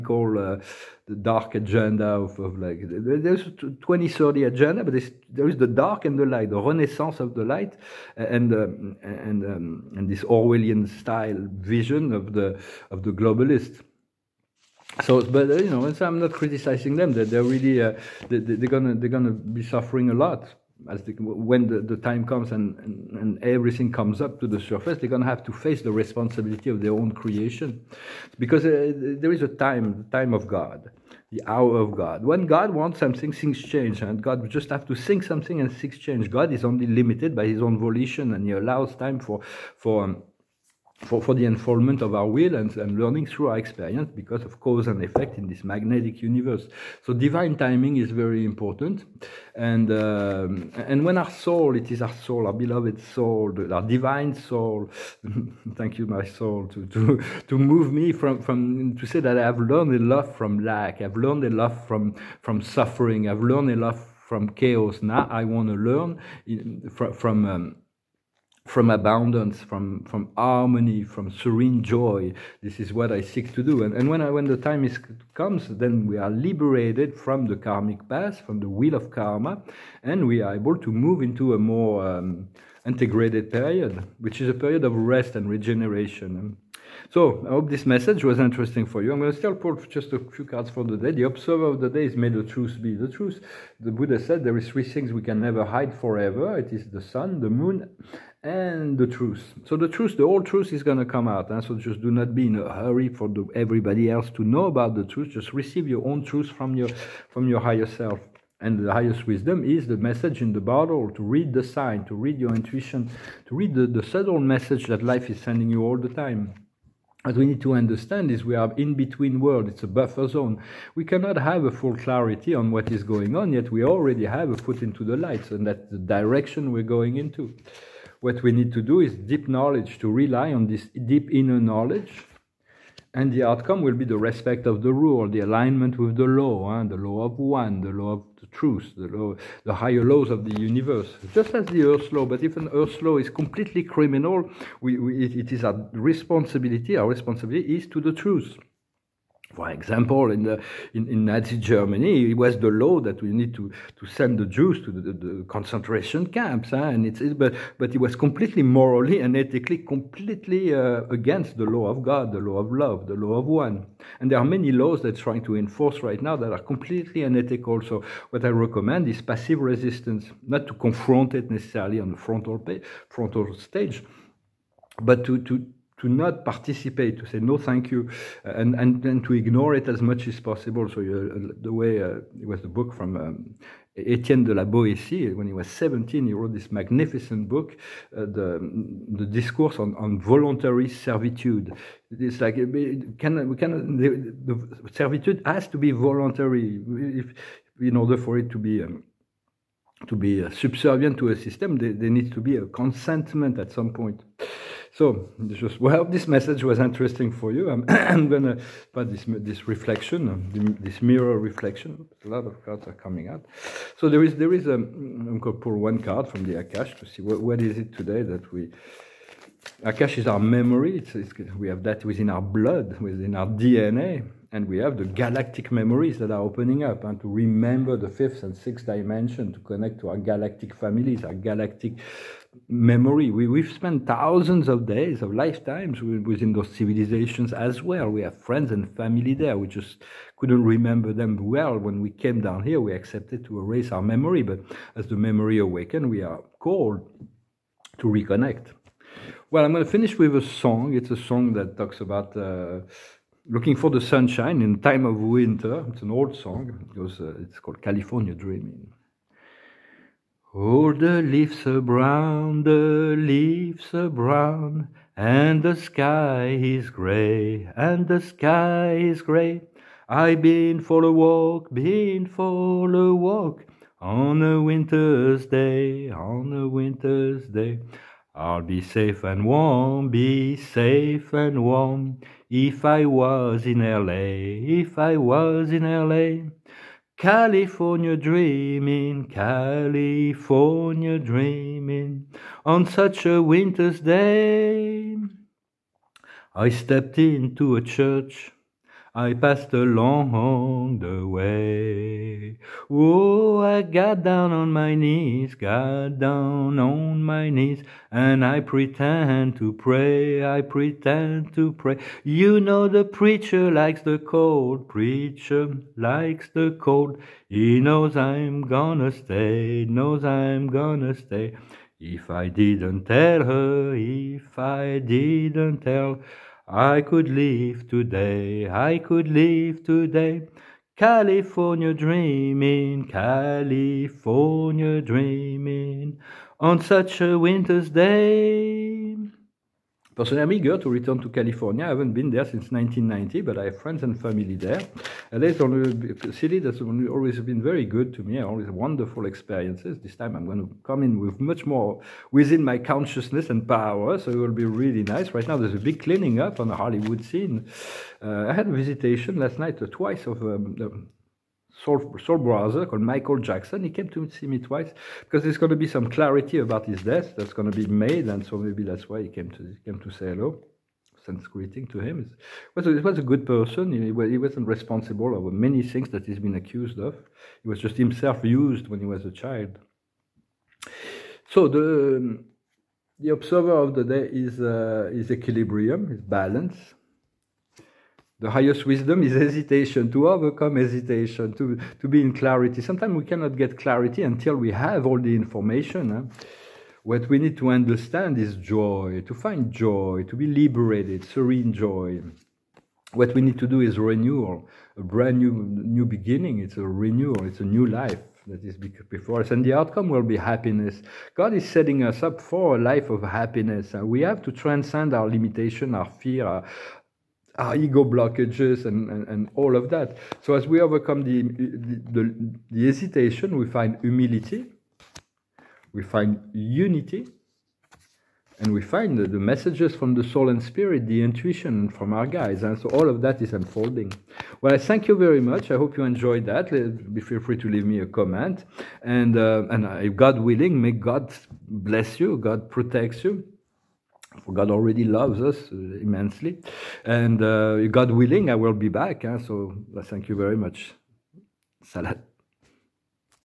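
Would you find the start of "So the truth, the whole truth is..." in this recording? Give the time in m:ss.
1:39.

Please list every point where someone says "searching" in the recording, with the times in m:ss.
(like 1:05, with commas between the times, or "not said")
not said.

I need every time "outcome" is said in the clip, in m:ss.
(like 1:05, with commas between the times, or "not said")
2:13, 6:49.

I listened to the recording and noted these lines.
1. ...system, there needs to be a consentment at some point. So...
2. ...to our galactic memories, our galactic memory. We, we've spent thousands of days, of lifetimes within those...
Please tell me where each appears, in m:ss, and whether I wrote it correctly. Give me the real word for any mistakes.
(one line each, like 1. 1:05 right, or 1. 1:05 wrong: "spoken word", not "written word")
1. 3:21 right
2. 3:50 wrong: "families", not "memories".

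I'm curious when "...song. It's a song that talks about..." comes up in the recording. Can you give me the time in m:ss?
4:10.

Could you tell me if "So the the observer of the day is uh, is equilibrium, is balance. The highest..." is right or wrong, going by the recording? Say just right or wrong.
right.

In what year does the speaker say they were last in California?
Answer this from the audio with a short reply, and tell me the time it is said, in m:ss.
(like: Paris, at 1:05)
1990, at 5:42.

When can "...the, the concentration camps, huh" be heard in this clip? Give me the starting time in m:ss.
2:34.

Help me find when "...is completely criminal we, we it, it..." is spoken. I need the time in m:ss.
2:23.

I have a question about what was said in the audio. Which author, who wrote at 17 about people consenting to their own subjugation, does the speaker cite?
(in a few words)
Etienne de la Boétie.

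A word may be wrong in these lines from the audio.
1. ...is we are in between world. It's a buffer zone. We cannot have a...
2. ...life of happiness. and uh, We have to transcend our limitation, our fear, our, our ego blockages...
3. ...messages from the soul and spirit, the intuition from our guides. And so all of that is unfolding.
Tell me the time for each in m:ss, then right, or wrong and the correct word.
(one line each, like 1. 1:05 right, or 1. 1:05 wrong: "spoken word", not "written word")
1. 1:58 right
2. 6:52 right
3. 7:09 right.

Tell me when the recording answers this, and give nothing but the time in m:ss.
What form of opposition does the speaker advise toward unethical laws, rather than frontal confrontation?
2:49.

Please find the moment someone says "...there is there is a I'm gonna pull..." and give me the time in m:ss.
3:34.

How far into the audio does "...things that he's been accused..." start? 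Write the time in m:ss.
6:15.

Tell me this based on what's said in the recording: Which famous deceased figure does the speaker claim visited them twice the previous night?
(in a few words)
Michael Jackson.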